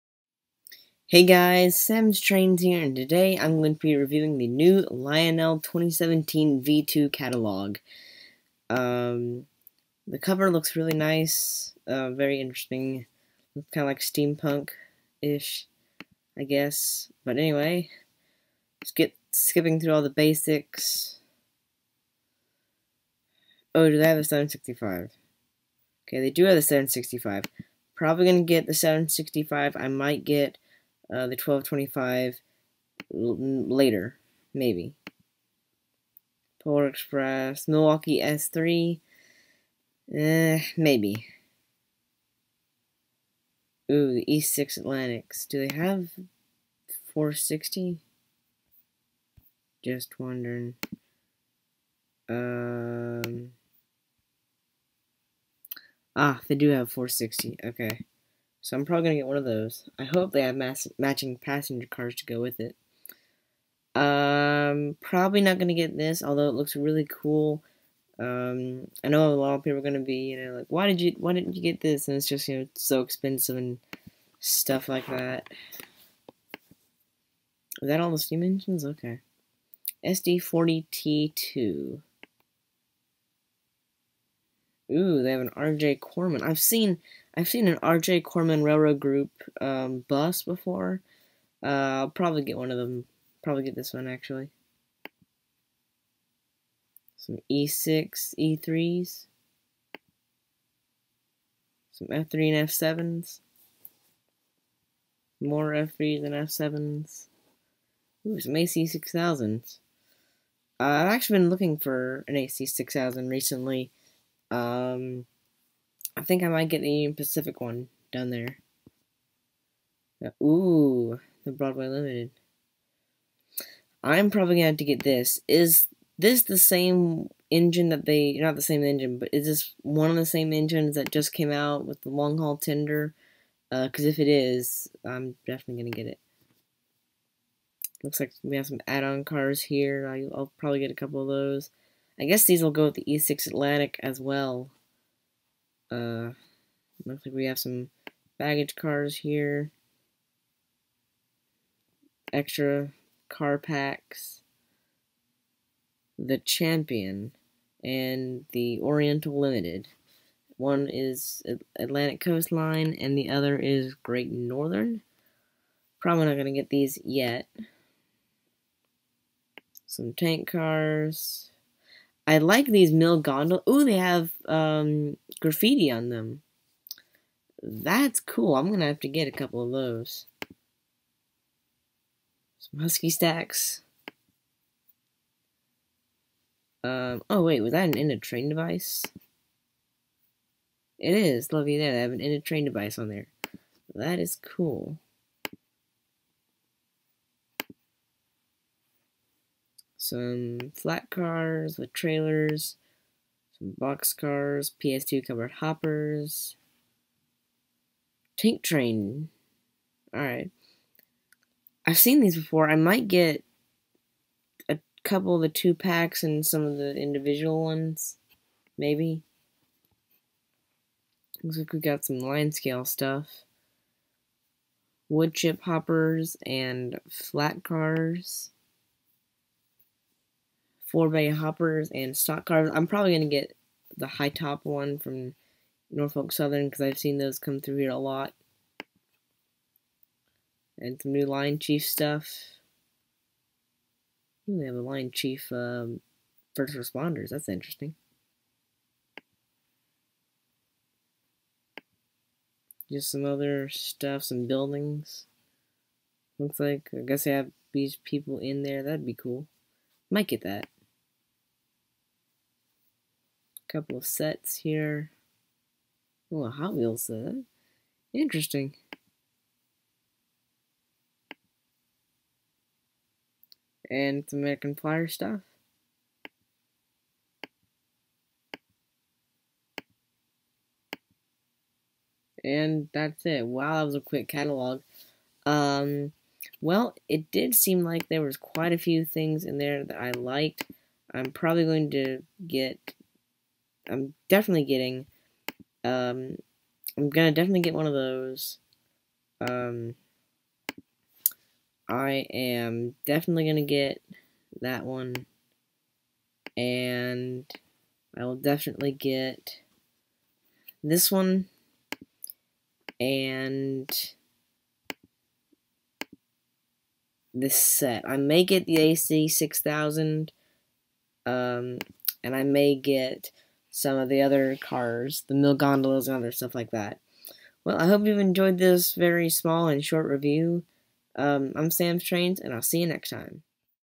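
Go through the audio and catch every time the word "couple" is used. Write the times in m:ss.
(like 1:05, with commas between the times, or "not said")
2:20, 2:59, 3:35, 4:23.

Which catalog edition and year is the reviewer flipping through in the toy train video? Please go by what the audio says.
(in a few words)
2017 V2.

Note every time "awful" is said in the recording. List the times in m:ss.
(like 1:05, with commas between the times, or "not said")
not said.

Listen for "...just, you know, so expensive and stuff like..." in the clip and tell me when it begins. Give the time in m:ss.
1:12.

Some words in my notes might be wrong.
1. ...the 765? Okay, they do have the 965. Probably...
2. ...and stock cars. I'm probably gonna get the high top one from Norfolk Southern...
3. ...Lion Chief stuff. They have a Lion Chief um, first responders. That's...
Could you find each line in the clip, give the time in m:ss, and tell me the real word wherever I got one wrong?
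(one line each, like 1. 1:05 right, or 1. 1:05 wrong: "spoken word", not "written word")
1. 0:24 wrong: "765", not "965"
2. 3:51 right
3. 4:01 right.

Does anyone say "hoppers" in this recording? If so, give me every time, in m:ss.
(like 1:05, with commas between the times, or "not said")
3:25, 3:45, 3:51.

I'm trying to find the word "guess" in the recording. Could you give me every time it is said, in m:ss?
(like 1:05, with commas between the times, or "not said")
0:16, 2:22, 4:17.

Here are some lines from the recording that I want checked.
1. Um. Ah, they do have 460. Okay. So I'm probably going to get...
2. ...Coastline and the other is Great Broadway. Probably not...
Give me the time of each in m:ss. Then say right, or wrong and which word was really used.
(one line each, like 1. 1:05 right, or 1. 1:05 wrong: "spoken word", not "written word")
1. 0:52 right
2. 2:42 wrong: "Northern", not "Broadway".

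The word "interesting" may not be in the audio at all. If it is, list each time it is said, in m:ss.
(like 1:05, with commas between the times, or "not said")
0:12, 4:07, 4:28.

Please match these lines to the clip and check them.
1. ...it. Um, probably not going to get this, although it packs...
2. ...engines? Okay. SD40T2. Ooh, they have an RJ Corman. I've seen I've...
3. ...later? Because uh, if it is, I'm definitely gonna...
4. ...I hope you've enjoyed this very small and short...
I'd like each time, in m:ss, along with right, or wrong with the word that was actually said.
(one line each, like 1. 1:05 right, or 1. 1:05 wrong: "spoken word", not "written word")
1. 1:02 wrong: "looks", not "packs"
2. 1:18 right
3. 2:12 wrong: "tender", not "later"
4. 5:27 right.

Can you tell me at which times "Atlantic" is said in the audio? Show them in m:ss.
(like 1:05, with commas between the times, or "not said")
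0:44, 2:23, 2:41.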